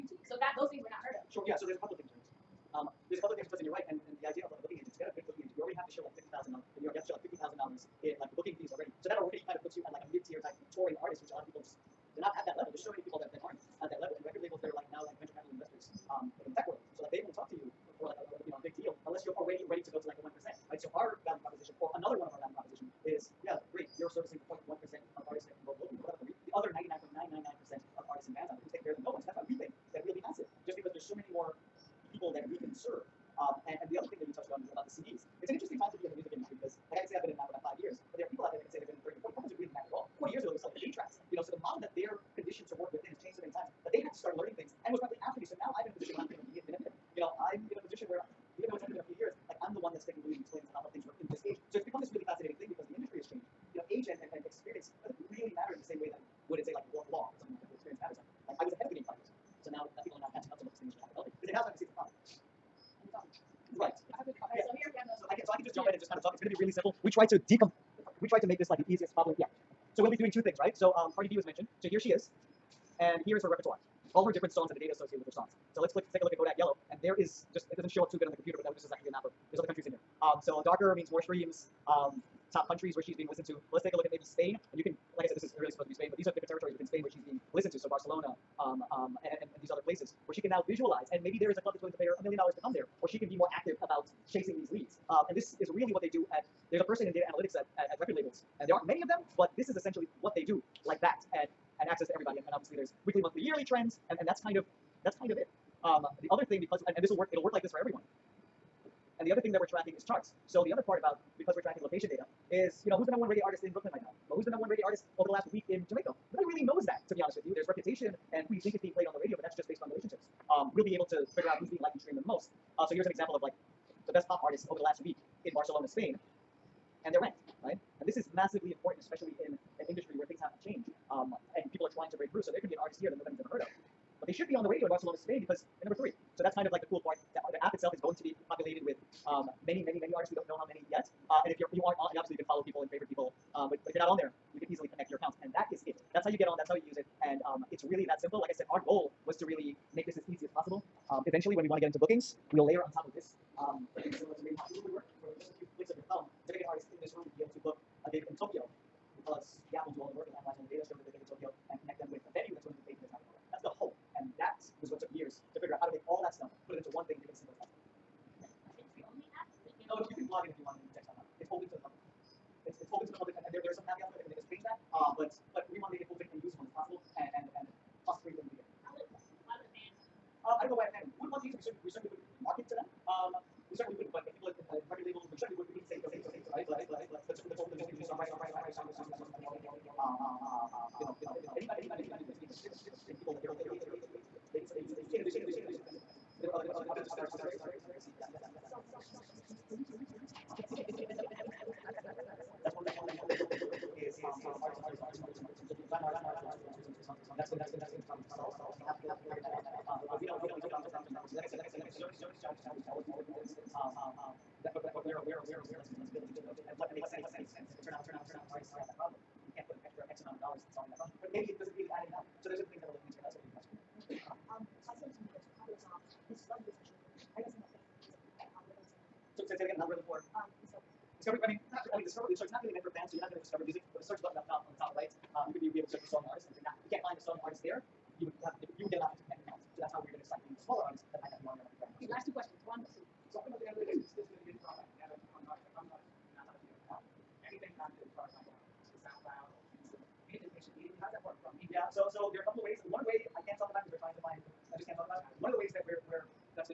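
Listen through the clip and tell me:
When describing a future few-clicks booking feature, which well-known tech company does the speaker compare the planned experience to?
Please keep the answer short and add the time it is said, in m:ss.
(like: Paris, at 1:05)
Google, at 2:34.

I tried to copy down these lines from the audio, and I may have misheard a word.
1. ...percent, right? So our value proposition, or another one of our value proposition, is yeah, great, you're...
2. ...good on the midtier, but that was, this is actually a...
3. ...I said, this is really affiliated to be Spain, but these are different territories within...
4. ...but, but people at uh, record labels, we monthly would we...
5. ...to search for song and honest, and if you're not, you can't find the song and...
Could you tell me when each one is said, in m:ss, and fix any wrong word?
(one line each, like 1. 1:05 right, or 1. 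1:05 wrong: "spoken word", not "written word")
1. 0:20 right
2. 1:18 wrong: "computer", not "midtier"
3. 1:25 wrong: "supposed", not "affiliated"
4. 3:04 wrong: "certainly", not "monthly"
5. 3:55 wrong: "artist", not "honest".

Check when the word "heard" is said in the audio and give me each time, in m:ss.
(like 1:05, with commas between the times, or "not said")
0:01, 2:13.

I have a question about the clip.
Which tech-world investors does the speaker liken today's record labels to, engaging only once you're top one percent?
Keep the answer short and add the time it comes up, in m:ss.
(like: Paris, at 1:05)
venture capital investors, at 0:15.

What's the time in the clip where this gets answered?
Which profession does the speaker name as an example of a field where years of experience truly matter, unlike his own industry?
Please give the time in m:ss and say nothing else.
0:56.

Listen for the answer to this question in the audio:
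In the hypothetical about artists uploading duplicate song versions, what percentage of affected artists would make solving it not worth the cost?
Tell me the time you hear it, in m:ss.
3:38.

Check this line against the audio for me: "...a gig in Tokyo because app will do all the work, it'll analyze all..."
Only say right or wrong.
right.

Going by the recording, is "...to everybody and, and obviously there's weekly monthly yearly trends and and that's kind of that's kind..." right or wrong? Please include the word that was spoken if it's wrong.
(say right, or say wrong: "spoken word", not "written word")
right.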